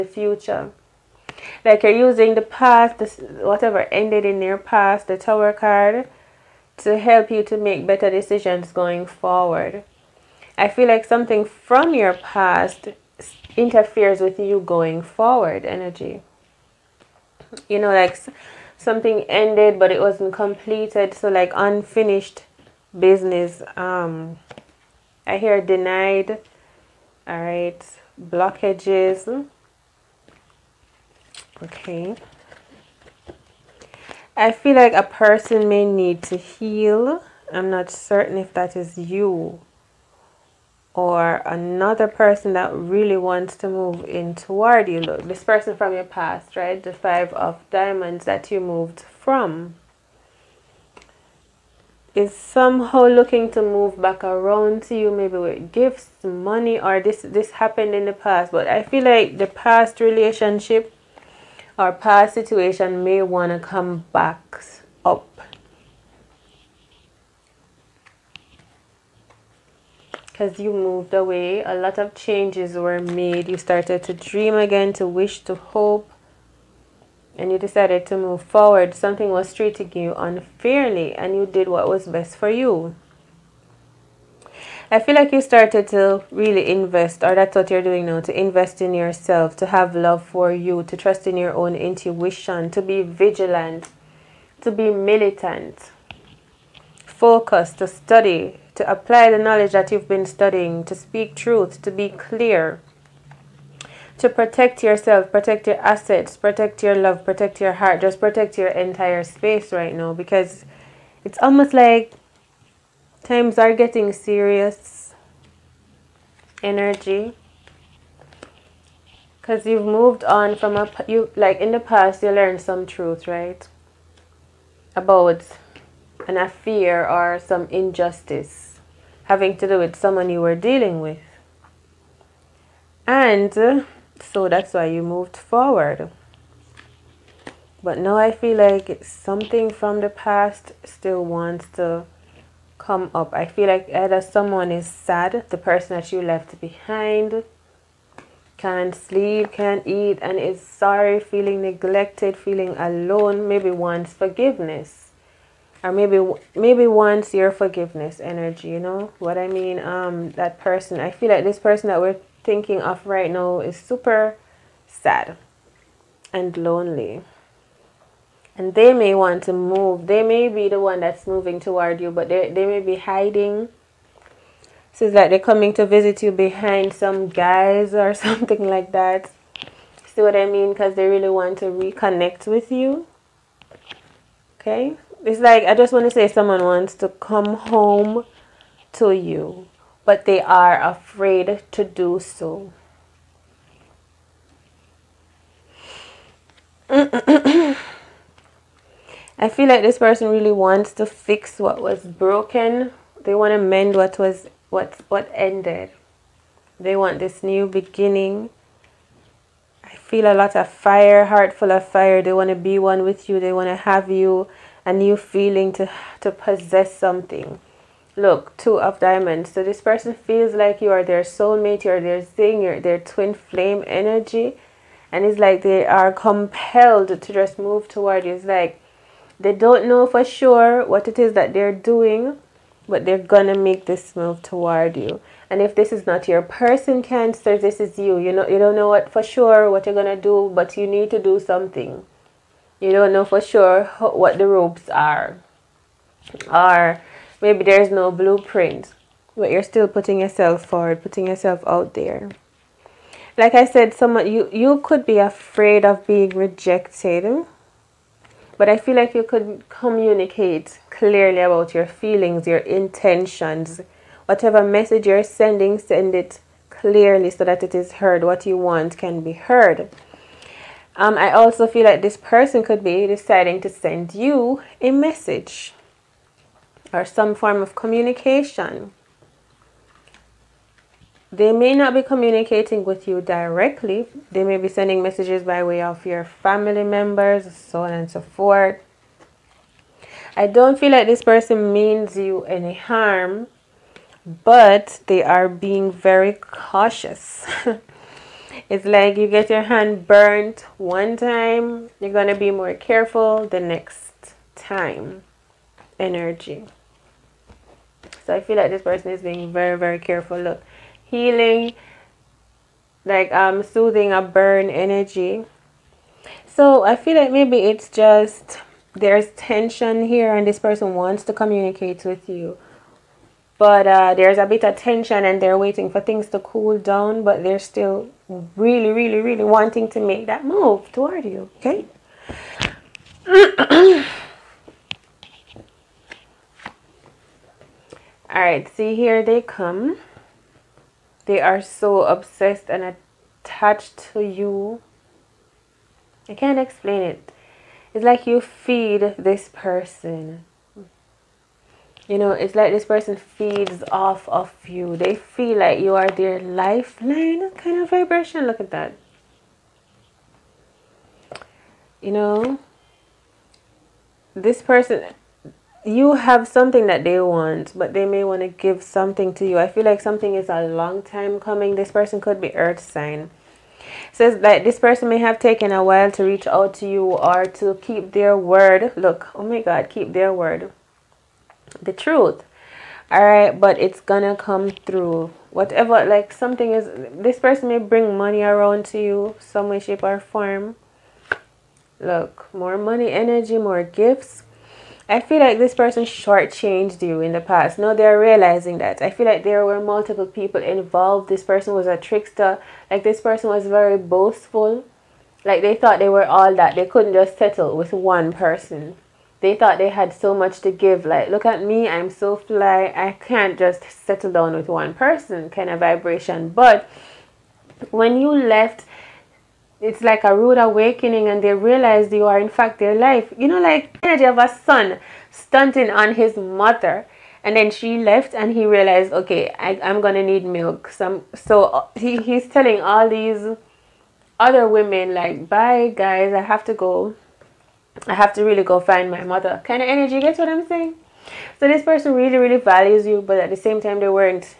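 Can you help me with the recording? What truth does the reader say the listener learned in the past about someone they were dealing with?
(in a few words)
An affair.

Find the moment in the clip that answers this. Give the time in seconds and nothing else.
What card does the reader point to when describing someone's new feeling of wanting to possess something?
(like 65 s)
218 s.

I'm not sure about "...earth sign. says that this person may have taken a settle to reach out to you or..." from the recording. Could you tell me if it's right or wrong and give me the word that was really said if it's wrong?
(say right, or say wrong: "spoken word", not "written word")
wrong: "while", not "settle".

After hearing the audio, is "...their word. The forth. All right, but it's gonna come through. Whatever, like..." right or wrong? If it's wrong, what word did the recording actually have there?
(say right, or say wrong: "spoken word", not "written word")
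wrong: "truth", not "forth".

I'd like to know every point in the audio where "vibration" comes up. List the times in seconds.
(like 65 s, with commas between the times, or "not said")
357 s, 415 s.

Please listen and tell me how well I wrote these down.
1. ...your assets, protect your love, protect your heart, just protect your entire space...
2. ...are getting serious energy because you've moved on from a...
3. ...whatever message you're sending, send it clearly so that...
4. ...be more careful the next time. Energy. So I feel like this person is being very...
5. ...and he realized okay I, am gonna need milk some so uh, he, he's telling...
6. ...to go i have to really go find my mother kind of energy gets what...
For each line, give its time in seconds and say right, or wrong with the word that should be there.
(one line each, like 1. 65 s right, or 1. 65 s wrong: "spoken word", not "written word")
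1. 105 s right
2. 113 s right
3. 264 s right
4. 302 s right
5. 428 s right
6. 436 s right.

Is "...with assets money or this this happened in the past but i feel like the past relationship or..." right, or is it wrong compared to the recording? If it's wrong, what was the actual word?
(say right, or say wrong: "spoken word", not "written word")
wrong: "gifts", not "assets".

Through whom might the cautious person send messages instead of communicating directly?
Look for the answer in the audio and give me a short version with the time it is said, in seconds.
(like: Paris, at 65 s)
Family members, at 286 s.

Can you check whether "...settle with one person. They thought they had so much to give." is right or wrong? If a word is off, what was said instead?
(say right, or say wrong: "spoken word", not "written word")
right.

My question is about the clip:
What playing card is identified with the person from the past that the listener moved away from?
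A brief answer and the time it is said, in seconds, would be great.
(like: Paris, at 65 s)
Five of diamonds, at 46 s.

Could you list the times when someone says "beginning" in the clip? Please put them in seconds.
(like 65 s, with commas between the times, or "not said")
207 s.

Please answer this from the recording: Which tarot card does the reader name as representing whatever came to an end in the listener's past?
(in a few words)
The Tower.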